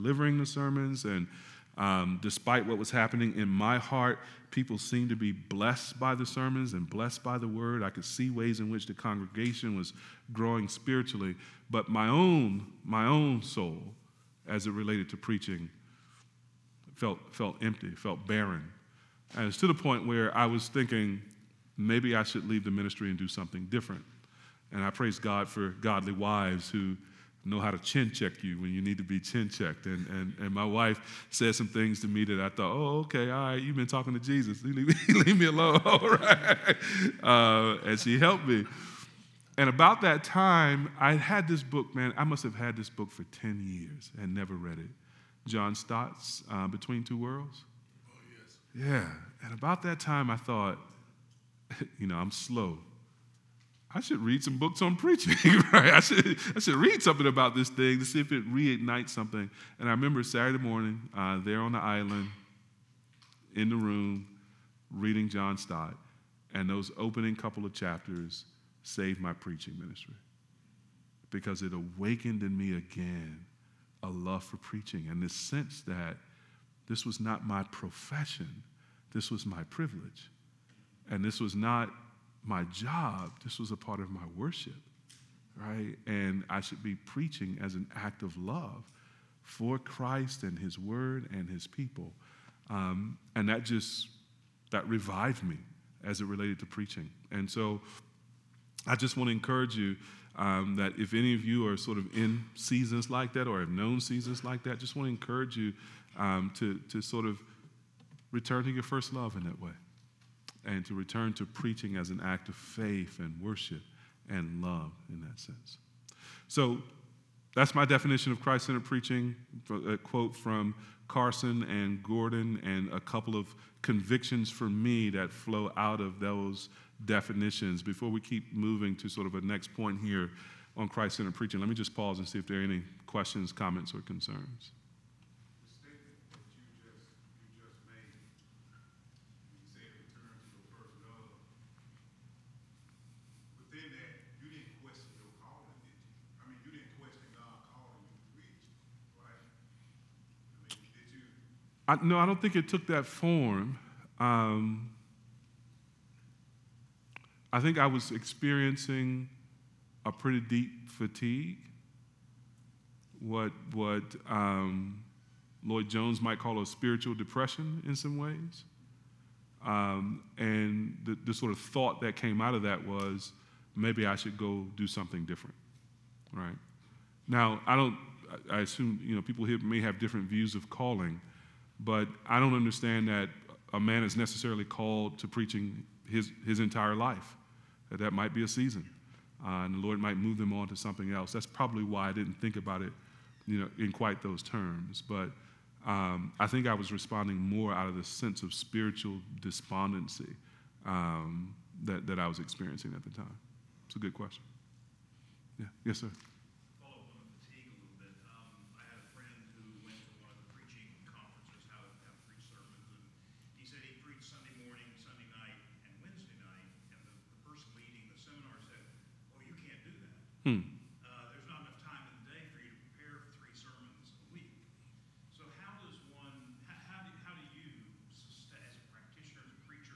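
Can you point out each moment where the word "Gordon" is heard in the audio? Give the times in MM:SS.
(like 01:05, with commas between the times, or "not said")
02:02.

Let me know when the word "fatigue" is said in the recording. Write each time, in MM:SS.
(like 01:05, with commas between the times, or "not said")
02:40.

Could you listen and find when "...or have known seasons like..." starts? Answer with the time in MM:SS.
01:43.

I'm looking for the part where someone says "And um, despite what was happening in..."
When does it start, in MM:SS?
00:01.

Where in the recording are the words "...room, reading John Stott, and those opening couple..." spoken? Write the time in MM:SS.
01:03.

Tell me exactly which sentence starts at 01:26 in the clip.
And I should be preaching as an act of love for Christ and His Word and His people.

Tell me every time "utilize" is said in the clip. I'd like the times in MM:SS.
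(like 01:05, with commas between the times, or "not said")
not said.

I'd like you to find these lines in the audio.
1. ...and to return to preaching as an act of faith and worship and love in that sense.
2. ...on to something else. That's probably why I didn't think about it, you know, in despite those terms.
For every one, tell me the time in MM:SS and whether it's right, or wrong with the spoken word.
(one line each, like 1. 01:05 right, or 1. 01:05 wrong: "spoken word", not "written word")
1. 01:50 right
2. 03:10 wrong: "quite", not "despite".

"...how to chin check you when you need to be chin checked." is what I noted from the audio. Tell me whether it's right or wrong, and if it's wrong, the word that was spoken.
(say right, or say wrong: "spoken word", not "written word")
right.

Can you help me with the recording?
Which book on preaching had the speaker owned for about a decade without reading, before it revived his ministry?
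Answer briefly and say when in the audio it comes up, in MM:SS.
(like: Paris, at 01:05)
Between Two Worlds, at 00:46.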